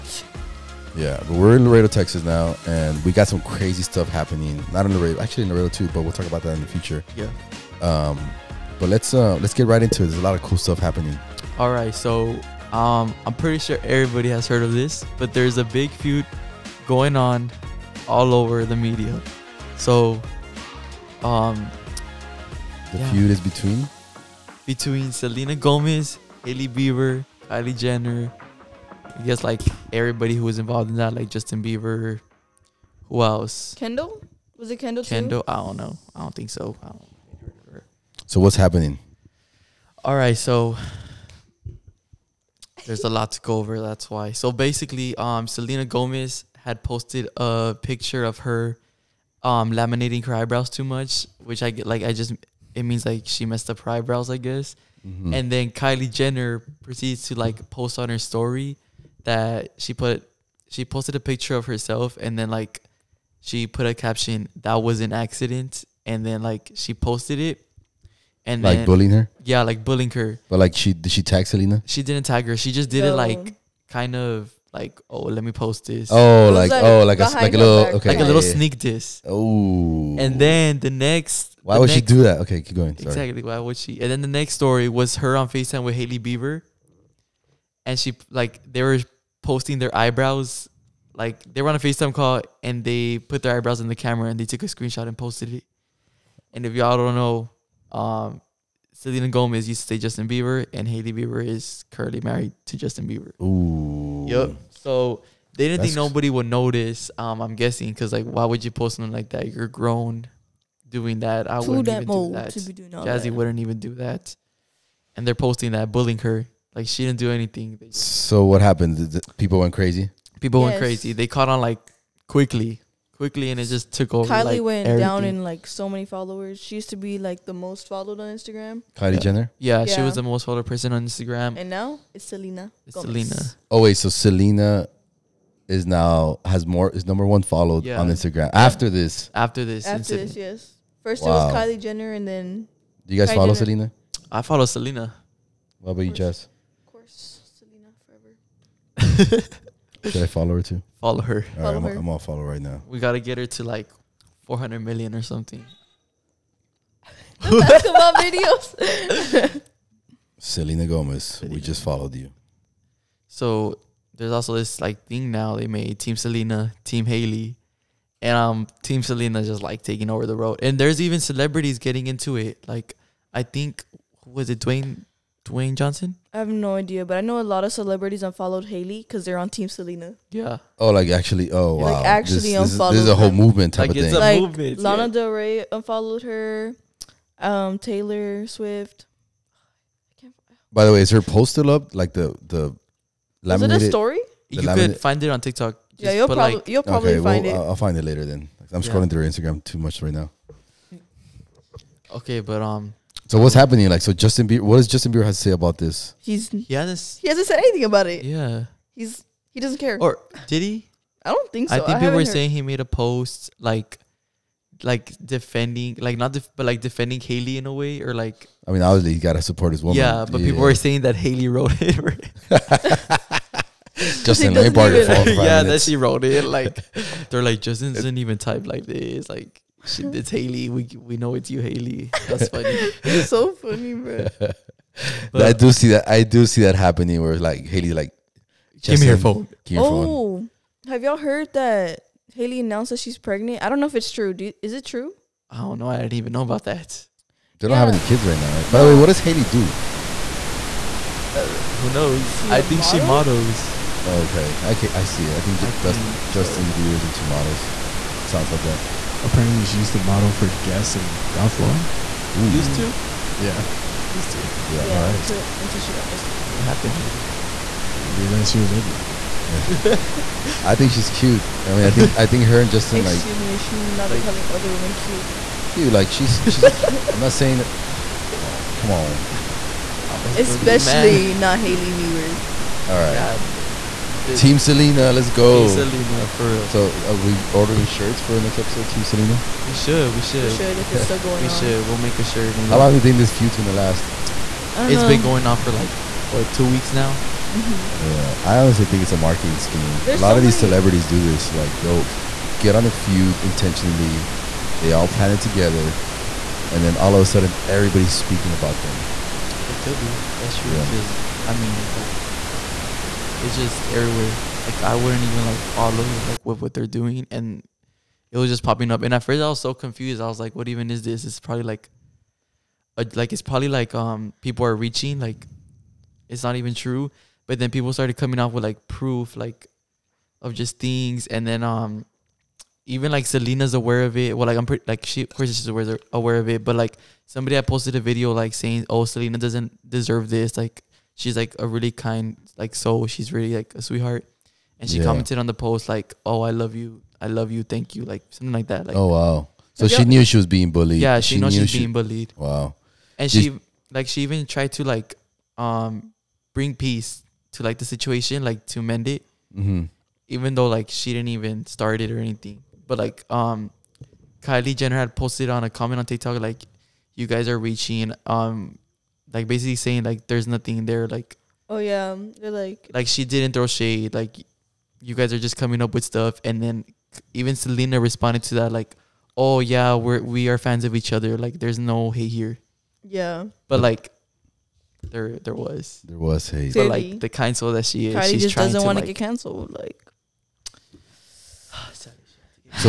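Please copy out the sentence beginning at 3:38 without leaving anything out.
I mean, obviously, he gotta support his woman.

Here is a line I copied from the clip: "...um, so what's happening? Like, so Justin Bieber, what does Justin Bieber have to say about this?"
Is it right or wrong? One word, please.
right.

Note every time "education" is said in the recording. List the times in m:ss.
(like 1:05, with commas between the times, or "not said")
not said.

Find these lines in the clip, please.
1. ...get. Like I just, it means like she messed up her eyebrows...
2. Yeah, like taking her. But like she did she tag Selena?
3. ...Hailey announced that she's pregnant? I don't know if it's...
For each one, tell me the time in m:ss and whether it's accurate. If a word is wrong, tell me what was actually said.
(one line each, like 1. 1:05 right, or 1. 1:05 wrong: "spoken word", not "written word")
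1. 0:51 right
2. 1:09 wrong: "bullying", not "taking"
3. 4:02 right.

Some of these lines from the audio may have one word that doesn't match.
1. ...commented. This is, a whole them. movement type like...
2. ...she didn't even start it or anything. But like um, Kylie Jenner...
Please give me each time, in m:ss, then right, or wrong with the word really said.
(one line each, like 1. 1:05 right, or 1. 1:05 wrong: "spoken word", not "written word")
1. 3:02 wrong: "unfollowed", not "commented"
2. 6:00 right.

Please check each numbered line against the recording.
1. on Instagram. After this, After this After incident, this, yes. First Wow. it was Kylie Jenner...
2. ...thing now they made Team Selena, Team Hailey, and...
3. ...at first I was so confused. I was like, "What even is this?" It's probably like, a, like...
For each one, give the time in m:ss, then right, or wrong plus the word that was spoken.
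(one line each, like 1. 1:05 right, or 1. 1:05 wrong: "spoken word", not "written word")
1. 2:18 right
2. 2:45 right
3. 5:19 right.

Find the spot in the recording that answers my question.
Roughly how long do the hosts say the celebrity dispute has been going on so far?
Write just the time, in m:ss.
4:56.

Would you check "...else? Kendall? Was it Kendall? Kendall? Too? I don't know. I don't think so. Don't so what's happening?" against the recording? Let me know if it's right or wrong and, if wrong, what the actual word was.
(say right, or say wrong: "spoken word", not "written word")
right.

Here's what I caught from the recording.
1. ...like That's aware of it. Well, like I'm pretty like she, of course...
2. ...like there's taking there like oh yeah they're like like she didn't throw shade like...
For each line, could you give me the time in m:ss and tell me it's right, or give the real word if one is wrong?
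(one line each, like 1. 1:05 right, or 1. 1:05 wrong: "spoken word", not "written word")
1. 5:33 wrong: "Selena", not "That"
2. 6:10 wrong: "nothing", not "taking".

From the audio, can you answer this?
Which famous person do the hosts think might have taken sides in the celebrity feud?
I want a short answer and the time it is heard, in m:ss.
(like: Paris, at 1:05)
Dwayne Johnson, at 2:55.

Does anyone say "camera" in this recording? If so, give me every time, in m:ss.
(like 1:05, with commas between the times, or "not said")
1:33.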